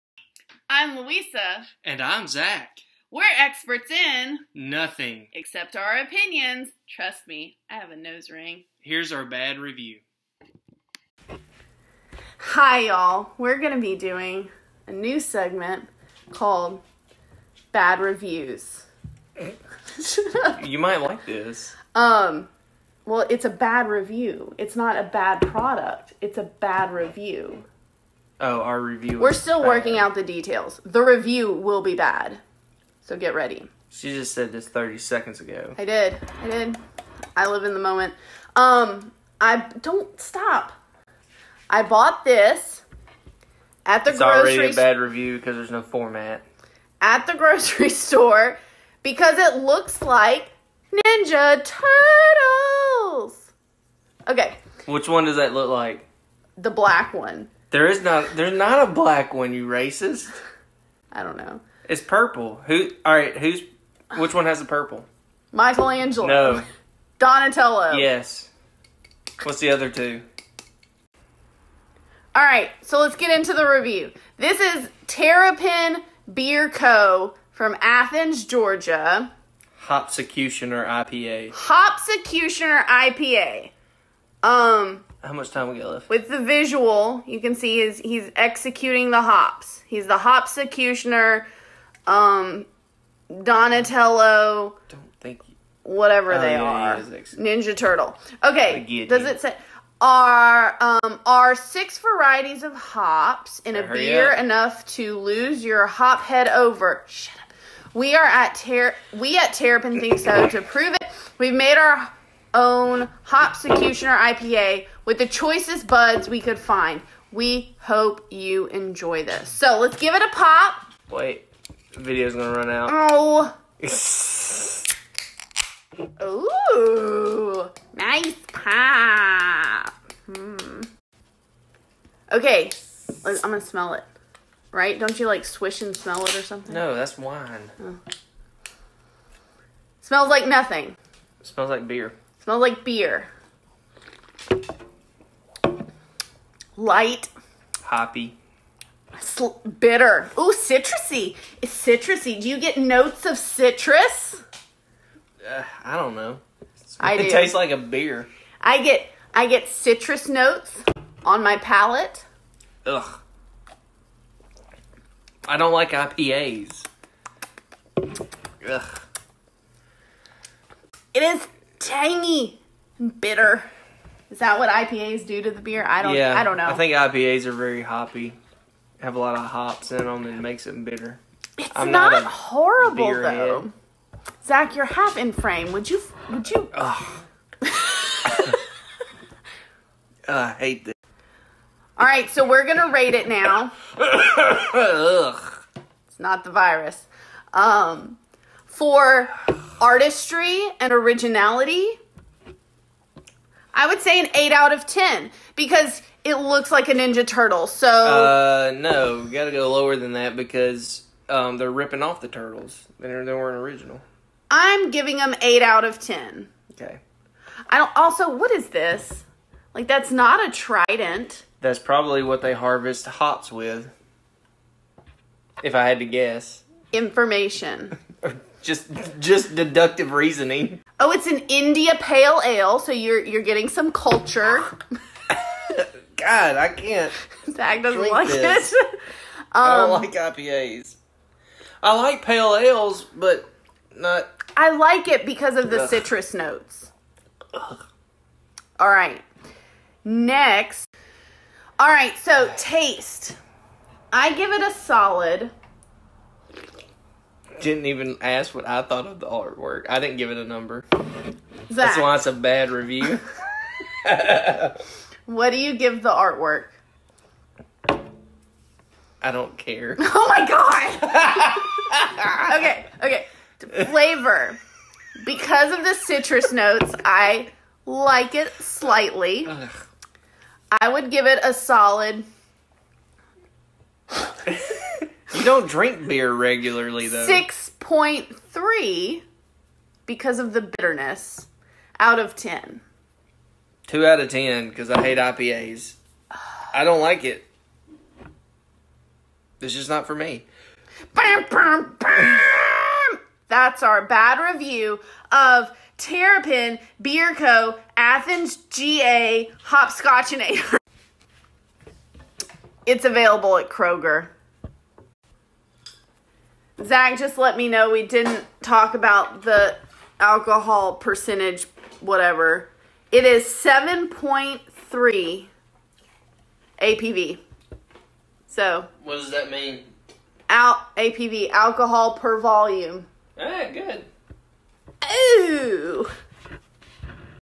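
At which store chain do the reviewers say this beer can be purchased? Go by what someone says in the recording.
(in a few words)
Kroger.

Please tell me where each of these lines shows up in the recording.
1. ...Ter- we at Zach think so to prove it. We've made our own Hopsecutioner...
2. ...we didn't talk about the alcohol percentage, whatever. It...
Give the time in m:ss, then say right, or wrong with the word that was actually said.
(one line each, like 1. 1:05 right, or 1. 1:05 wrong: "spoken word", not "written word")
1. 1:48 wrong: "Terrapin", not "Zach"
2. 5:17 right.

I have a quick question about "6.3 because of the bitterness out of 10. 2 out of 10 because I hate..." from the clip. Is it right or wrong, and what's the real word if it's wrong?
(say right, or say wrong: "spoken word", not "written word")
right.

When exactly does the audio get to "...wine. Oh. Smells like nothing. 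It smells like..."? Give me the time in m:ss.
2:17.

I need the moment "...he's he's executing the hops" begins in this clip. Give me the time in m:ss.
1:27.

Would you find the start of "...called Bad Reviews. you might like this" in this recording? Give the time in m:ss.
0:16.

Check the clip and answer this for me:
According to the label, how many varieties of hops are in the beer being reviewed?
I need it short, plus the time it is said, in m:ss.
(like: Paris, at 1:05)
6, at 1:41.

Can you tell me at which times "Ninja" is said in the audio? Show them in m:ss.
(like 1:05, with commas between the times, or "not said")
0:50, 1:36, 3:26.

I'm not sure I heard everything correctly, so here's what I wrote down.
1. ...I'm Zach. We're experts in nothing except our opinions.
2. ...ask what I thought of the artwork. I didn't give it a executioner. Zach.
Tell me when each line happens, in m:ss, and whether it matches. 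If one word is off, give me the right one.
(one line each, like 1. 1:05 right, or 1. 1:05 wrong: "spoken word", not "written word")
1. 0:01 right
2. 4:18 wrong: "number", not "executioner".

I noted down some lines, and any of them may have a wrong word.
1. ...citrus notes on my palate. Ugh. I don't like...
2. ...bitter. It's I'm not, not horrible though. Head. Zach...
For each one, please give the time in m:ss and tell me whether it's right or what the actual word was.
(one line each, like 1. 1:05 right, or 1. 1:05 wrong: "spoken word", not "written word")
1. 2:39 right
2. 3:00 right.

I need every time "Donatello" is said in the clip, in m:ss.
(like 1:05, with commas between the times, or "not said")
1:07, 1:33.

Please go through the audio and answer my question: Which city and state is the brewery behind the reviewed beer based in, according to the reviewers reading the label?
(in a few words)
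Athens, Georgia.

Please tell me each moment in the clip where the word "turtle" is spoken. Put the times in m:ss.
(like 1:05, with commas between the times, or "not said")
0:51, 1:37, 3:27, 3:32.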